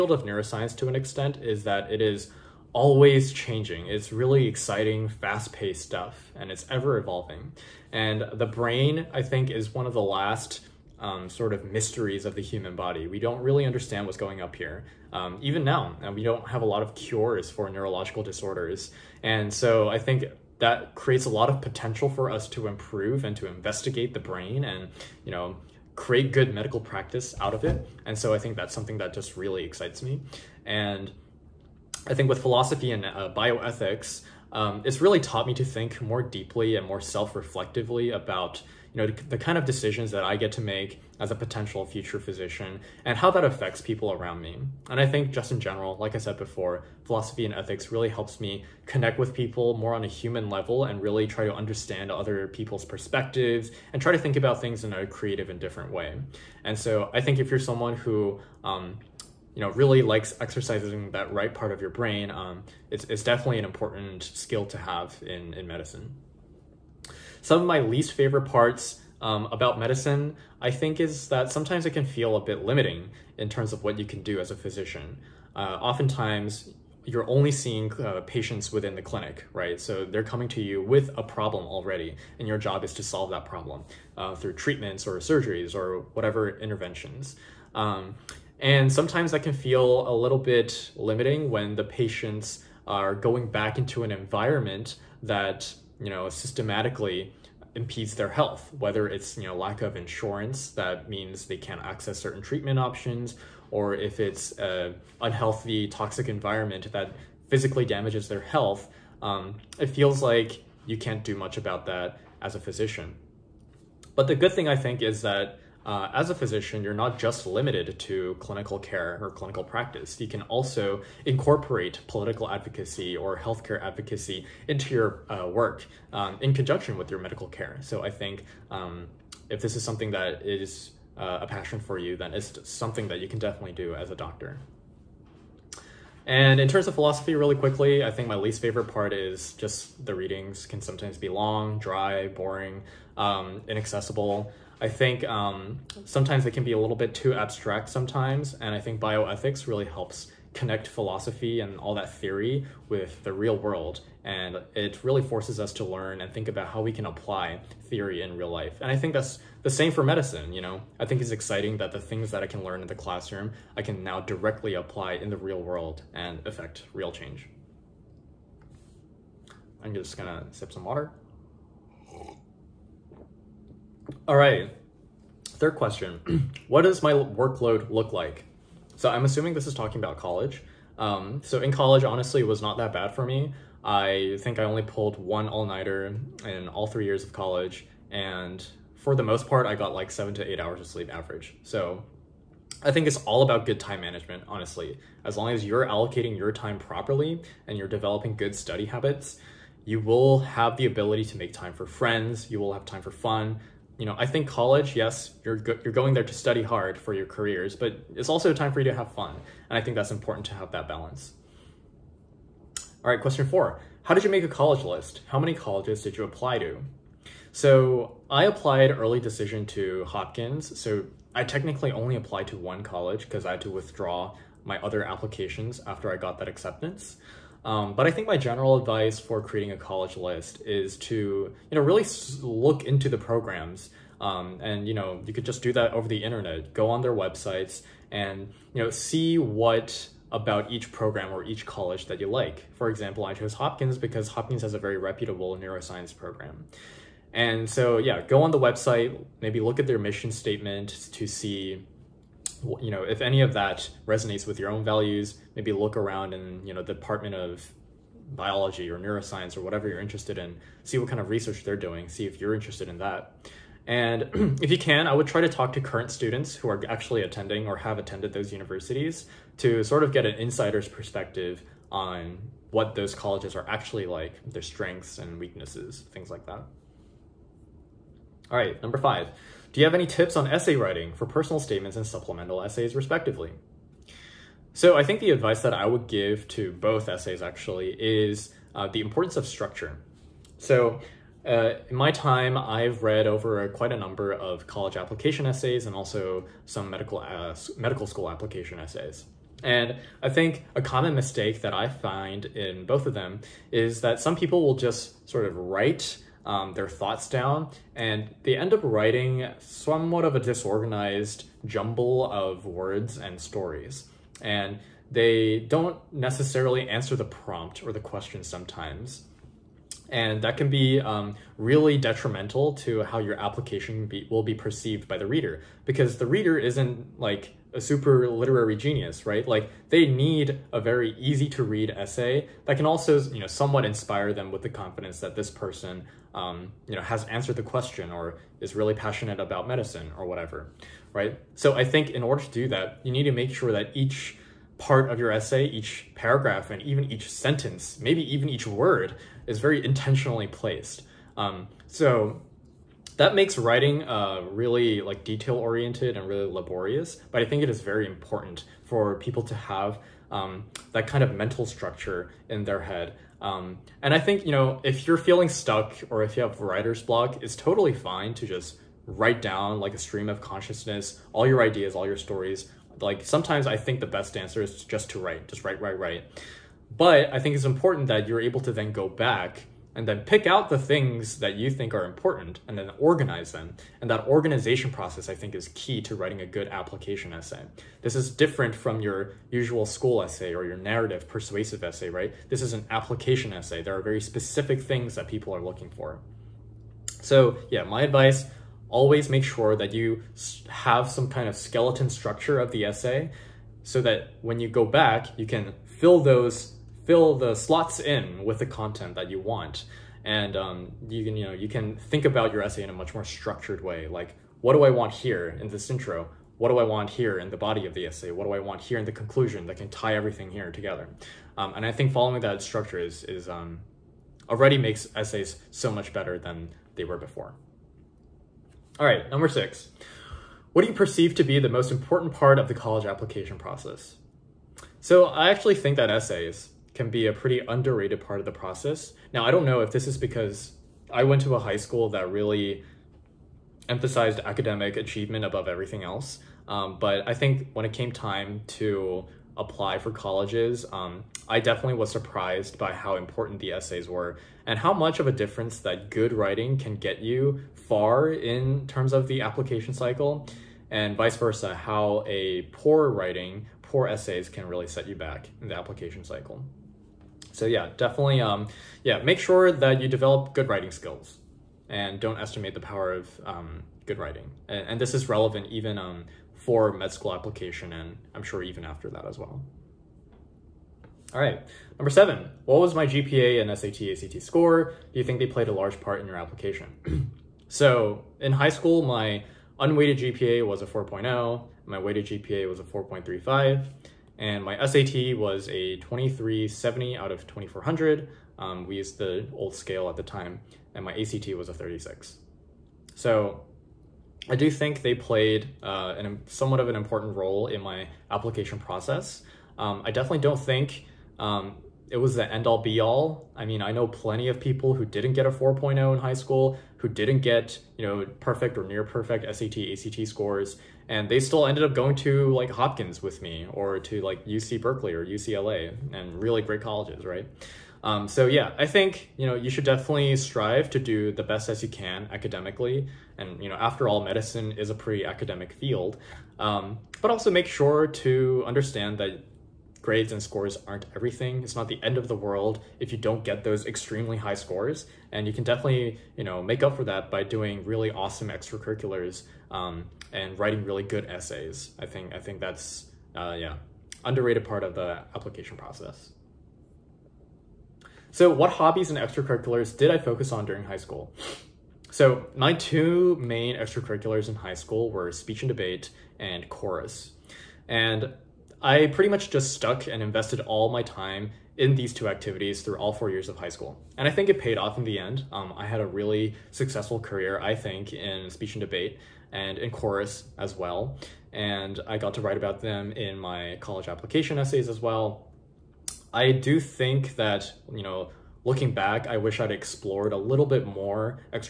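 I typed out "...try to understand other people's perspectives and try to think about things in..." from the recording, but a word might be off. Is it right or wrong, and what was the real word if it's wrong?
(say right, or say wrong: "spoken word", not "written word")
right.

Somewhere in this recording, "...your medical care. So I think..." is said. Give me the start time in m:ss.
2:07.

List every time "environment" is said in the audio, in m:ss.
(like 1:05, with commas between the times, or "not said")
1:34, 1:46.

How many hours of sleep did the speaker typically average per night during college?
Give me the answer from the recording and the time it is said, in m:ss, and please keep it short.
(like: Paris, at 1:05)
7 to 8, at 3:10.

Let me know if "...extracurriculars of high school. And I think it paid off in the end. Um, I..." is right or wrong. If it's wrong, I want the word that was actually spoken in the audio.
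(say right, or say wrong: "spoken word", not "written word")
wrong: "years", not "extracurriculars".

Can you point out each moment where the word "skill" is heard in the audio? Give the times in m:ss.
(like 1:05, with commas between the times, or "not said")
1:04, 7:50.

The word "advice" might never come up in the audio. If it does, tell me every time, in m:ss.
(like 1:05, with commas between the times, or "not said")
3:48, 4:45, 6:38.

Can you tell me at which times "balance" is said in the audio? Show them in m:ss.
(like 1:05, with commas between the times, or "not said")
3:30.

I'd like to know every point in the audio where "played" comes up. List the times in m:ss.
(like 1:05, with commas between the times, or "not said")
8:05, 8:25.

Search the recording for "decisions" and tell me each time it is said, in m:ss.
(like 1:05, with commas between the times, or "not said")
0:39, 3:39.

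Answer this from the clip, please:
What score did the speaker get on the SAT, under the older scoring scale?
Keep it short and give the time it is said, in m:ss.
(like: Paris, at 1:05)
2370, at 8:15.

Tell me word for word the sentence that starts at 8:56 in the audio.
Um, but also make sure to understand that grades and scores aren't everything.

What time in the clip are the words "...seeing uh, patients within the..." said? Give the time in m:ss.
1:17.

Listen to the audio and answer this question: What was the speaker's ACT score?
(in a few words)
36.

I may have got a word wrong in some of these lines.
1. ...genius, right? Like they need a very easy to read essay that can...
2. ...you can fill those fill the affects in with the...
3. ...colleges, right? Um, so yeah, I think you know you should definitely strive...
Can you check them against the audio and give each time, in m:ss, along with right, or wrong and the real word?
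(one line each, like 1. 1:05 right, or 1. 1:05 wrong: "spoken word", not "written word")
1. 5:28 right
2. 6:45 wrong: "slots", not "affects"
3. 8:46 right.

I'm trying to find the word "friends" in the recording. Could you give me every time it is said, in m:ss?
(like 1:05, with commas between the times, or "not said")
3:21.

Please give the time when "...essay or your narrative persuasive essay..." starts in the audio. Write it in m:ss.
6:30.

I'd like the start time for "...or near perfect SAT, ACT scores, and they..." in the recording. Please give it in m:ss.
8:38.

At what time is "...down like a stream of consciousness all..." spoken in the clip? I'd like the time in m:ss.
6:09.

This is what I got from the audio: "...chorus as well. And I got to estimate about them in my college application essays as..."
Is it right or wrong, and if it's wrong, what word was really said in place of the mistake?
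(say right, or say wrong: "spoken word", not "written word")
wrong: "write", not "estimate".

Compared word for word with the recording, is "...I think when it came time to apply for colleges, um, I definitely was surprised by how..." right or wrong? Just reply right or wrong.
right.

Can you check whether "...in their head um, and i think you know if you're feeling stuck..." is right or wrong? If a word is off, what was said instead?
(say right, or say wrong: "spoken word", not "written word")
right.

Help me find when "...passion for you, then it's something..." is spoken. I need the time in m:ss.
2:11.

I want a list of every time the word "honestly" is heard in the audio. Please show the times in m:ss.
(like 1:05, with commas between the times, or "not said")
3:02, 3:14.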